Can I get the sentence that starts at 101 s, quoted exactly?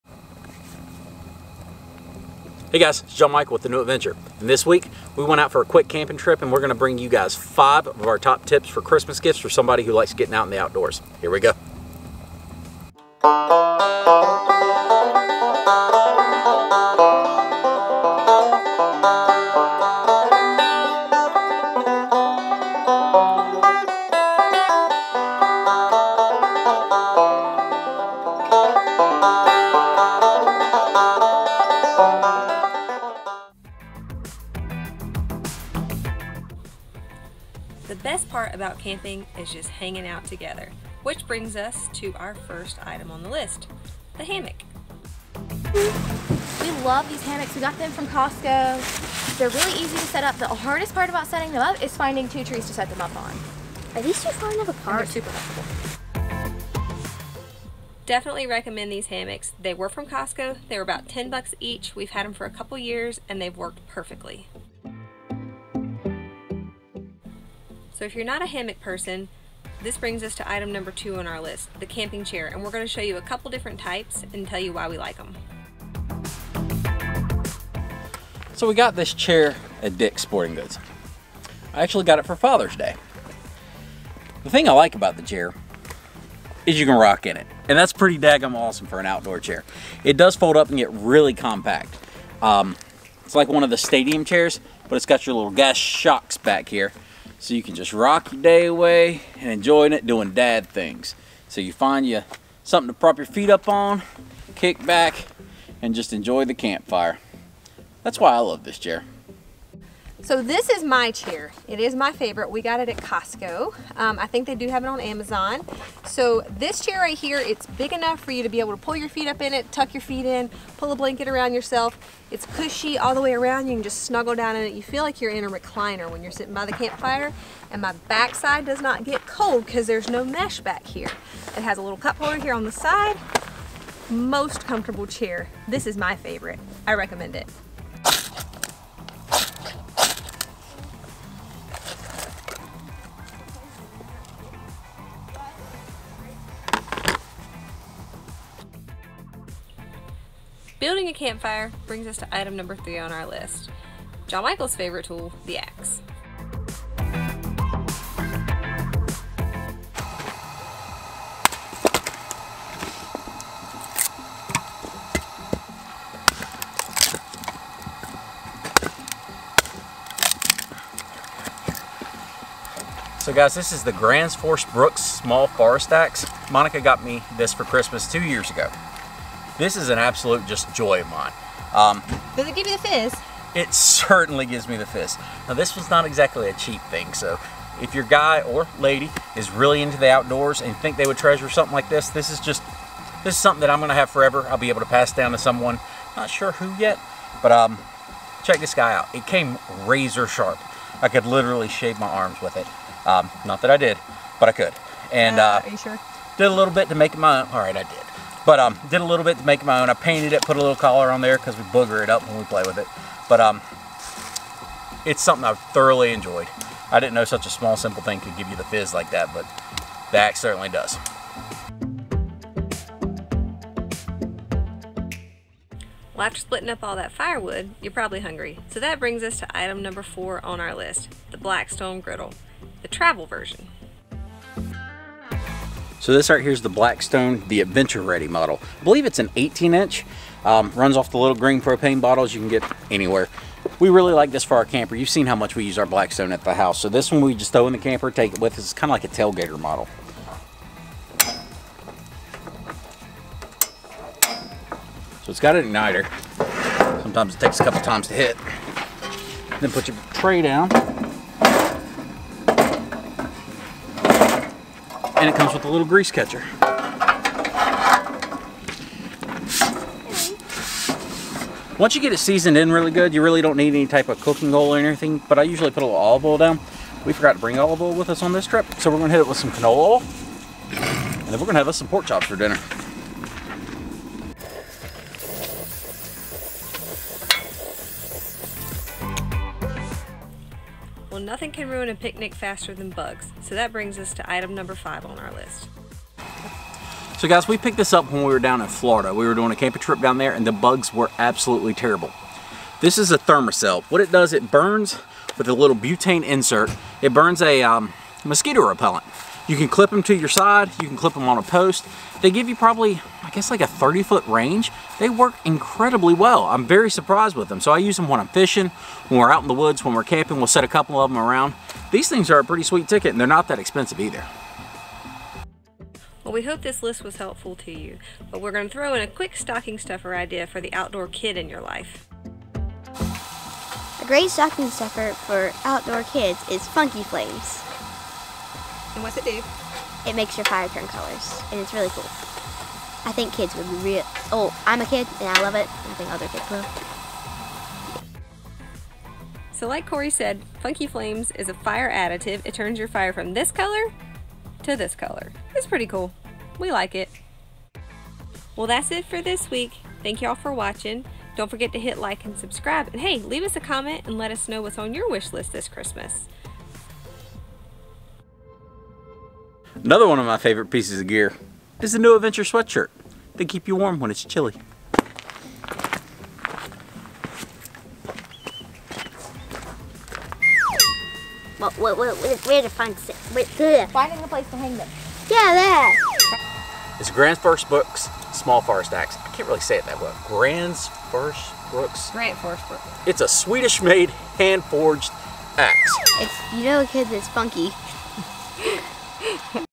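So you find you something to prop your feet up on, kick back, and just enjoy the campfire.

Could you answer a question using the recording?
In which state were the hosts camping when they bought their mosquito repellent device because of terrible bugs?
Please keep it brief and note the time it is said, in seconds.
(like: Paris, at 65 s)
Florida, at 298 s.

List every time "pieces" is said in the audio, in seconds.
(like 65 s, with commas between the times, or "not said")
370 s.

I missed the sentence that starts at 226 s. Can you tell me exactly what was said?
Well, after splitting up all that firewood, you're probably hungry.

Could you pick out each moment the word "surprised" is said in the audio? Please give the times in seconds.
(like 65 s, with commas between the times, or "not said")
316 s.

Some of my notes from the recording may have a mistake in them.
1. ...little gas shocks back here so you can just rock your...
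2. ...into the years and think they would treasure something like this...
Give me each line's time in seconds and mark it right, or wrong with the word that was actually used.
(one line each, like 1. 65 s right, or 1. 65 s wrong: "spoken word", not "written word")
1. 95 s right
2. 189 s wrong: "outdoors", not "years".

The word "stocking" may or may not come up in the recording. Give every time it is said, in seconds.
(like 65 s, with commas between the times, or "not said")
329 s, 334 s.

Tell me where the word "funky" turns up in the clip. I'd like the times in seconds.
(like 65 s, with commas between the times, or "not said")
336 s, 350 s, 397 s.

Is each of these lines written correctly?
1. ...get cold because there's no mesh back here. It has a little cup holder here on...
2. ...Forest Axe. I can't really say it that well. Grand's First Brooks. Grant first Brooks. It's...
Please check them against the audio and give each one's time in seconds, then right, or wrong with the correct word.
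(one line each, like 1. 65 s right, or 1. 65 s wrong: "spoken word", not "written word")
1. 129 s right
2. 388 s right.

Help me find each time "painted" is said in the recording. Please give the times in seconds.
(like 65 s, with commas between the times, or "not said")
209 s.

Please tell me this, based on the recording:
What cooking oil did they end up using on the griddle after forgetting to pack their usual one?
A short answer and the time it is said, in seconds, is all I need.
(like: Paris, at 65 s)
canola oil, at 279 s.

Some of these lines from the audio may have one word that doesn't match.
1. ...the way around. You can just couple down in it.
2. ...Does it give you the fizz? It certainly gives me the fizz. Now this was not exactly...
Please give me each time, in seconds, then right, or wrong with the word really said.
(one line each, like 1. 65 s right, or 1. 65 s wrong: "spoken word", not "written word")
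1. 123 s wrong: "snuggle", not "couple"
2. 182 s right.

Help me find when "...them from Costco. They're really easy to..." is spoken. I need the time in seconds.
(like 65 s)
47 s.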